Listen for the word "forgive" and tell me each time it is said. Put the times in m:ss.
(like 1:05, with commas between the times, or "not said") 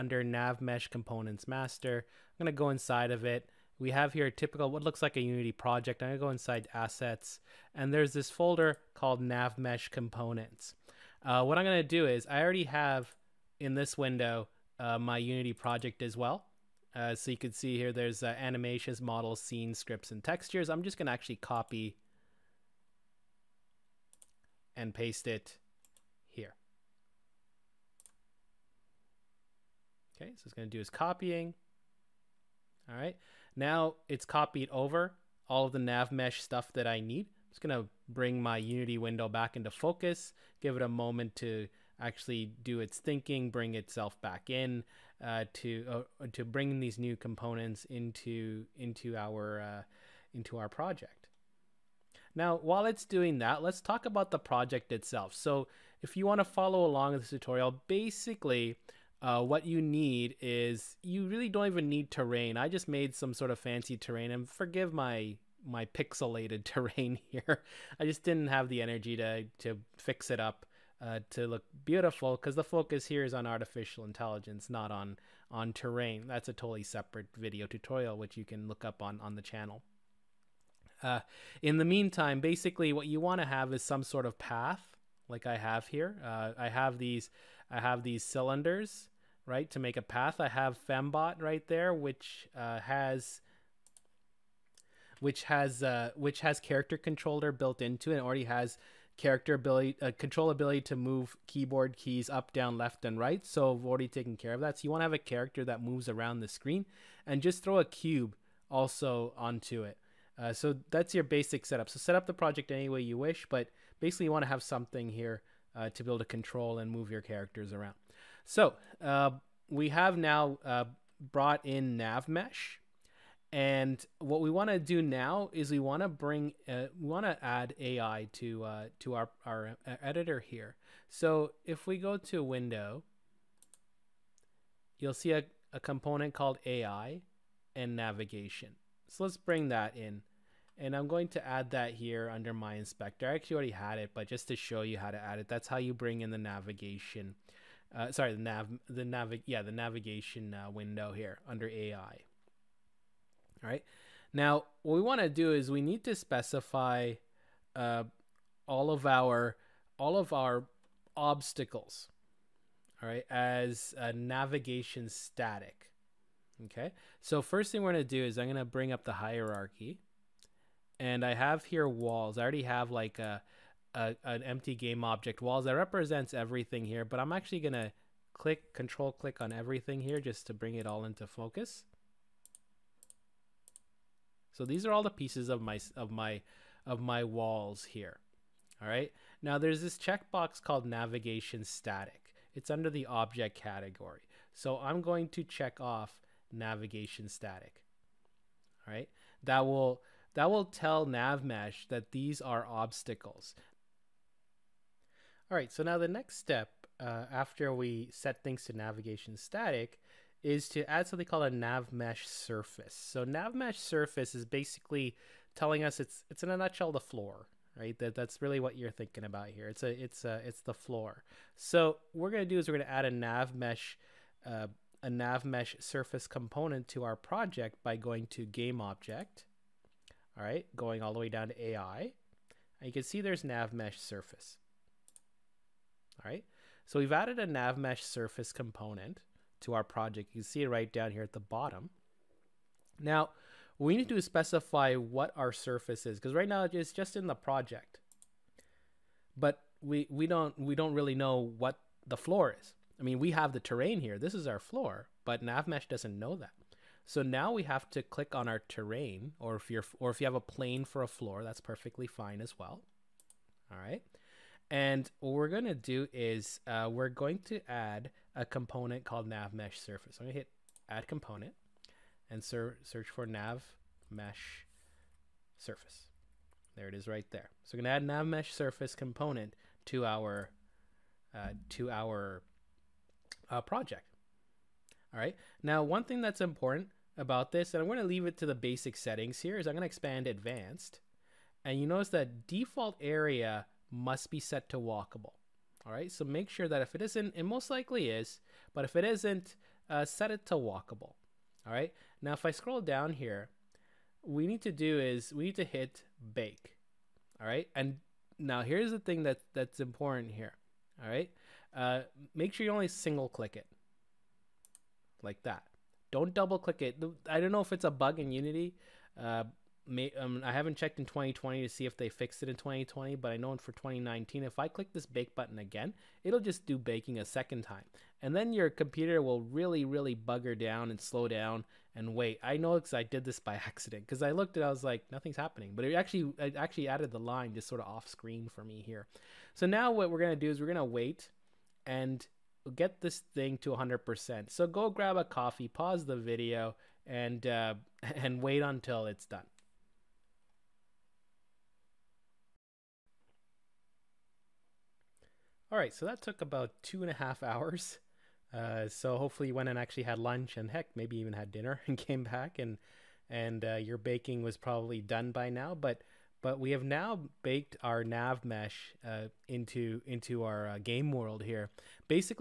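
1:04.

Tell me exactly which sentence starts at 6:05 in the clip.
But but we have now baked our nav mesh uh, into into our uh, game world here.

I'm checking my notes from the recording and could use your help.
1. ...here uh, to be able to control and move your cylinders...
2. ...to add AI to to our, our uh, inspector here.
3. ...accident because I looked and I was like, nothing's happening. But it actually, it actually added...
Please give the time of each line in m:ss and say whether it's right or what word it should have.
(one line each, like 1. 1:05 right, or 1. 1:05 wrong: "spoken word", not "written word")
1. 1:55 wrong: "characters", not "cylinders"
2. 2:07 wrong: "editor", not "inspector"
3. 5:33 right.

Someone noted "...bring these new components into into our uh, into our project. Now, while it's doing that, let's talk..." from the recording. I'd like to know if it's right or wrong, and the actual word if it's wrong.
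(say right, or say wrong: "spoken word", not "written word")
right.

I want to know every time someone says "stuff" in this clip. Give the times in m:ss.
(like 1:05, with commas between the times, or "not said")
0:36.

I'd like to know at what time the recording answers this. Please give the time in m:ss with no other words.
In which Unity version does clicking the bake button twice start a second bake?
5:23.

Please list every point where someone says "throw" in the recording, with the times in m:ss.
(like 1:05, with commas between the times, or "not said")
1:47.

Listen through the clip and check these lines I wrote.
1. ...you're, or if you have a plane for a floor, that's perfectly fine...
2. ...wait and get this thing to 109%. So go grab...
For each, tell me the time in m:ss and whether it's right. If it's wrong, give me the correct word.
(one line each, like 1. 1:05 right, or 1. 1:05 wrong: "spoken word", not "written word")
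1. 4:19 right
2. 5:40 wrong: "100", not "109".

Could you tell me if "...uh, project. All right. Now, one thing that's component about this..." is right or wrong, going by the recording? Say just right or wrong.
wrong.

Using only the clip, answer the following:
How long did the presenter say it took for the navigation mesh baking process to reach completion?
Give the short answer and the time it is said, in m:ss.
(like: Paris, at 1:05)
About two and a half hours, at 5:56.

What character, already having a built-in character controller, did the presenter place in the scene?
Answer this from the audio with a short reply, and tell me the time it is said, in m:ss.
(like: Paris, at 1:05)
Fembot, at 1:30.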